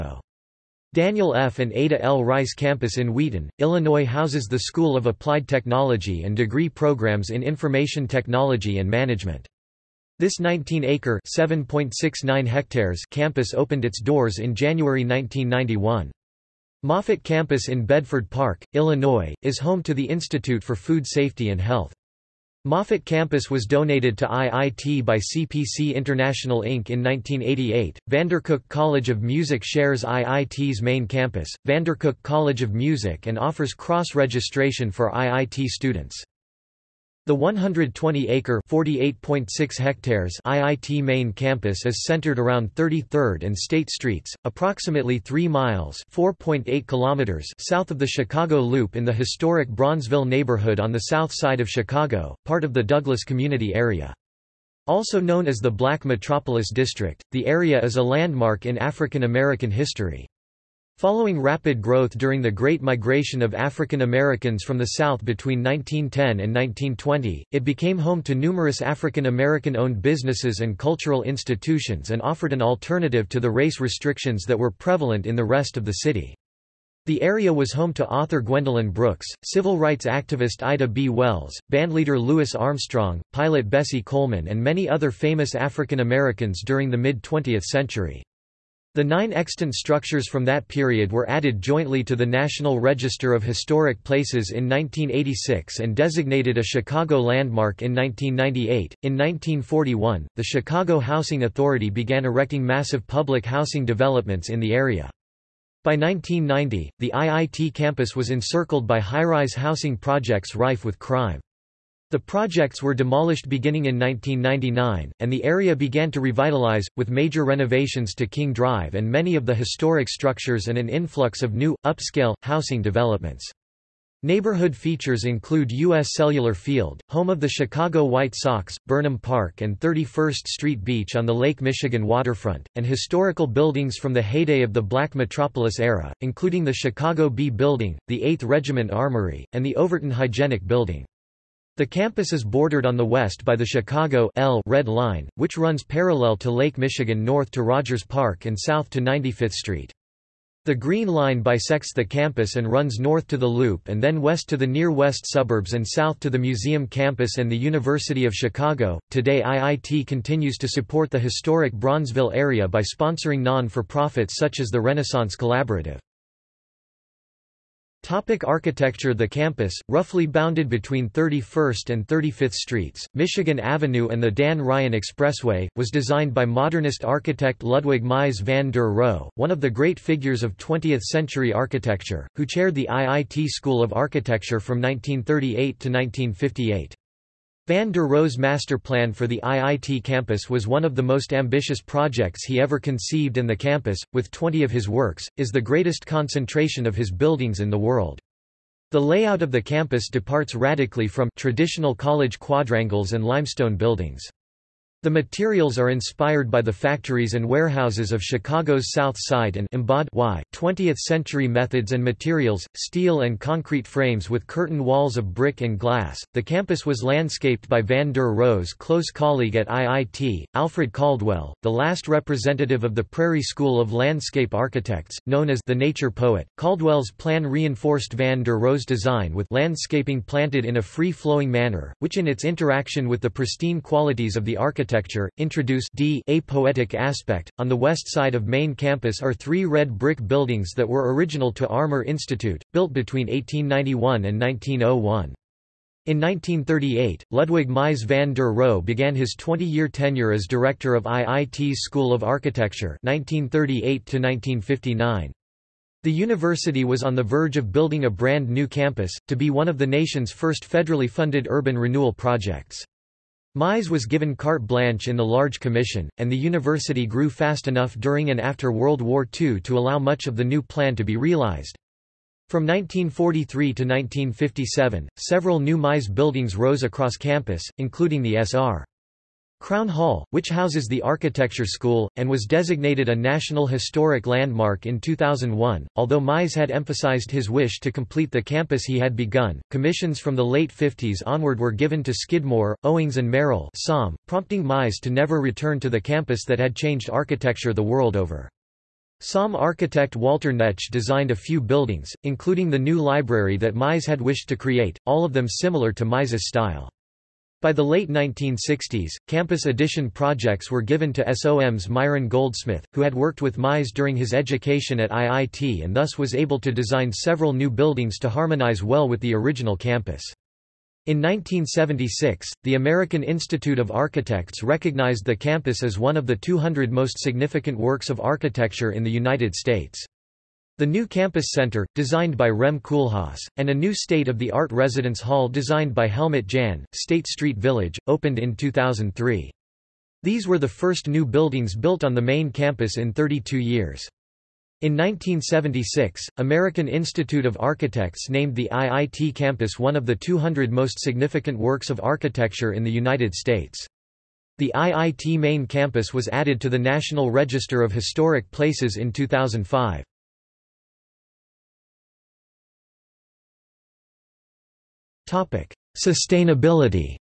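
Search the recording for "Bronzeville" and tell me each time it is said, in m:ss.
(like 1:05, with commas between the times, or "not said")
0:49, 2:41.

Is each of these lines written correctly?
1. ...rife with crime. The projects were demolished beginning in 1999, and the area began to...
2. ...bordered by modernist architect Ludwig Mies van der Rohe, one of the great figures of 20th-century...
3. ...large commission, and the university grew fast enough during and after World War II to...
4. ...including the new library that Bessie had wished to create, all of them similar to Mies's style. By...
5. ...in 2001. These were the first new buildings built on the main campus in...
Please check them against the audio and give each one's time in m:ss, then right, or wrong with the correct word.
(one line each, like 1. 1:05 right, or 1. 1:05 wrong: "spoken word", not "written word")
1. 1:50 right
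2. 2:55 wrong: "designed", not "bordered"
3. 4:25 right
4. 5:02 wrong: "Mies", not "Bessie"
5. 5:38 wrong: "2003", not "2001".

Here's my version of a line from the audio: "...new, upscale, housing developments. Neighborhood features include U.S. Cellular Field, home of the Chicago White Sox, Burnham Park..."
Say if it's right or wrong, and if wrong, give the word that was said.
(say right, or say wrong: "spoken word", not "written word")
right.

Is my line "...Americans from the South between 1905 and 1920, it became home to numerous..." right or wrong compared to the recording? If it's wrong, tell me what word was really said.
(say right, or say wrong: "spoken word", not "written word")
wrong: "1910", not "1905".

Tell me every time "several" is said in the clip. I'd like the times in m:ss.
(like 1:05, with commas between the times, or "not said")
4:35, 5:17.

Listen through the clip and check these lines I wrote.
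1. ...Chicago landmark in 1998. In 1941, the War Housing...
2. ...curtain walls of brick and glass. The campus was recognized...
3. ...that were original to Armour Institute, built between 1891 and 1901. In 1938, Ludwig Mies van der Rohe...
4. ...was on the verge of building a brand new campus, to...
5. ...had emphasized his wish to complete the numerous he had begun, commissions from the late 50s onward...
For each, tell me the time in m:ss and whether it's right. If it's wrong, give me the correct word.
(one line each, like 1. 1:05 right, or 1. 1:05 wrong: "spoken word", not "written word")
1. 1:36 wrong: "Chicago", not "War"
2. 3:34 wrong: "landscaped", not "recognized"
3. 4:00 right
4. 4:16 right
5. 4:46 wrong: "campus", not "numerous".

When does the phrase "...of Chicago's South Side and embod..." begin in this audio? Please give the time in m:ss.
3:28.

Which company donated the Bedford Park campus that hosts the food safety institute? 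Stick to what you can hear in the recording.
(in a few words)
CPC International Inc.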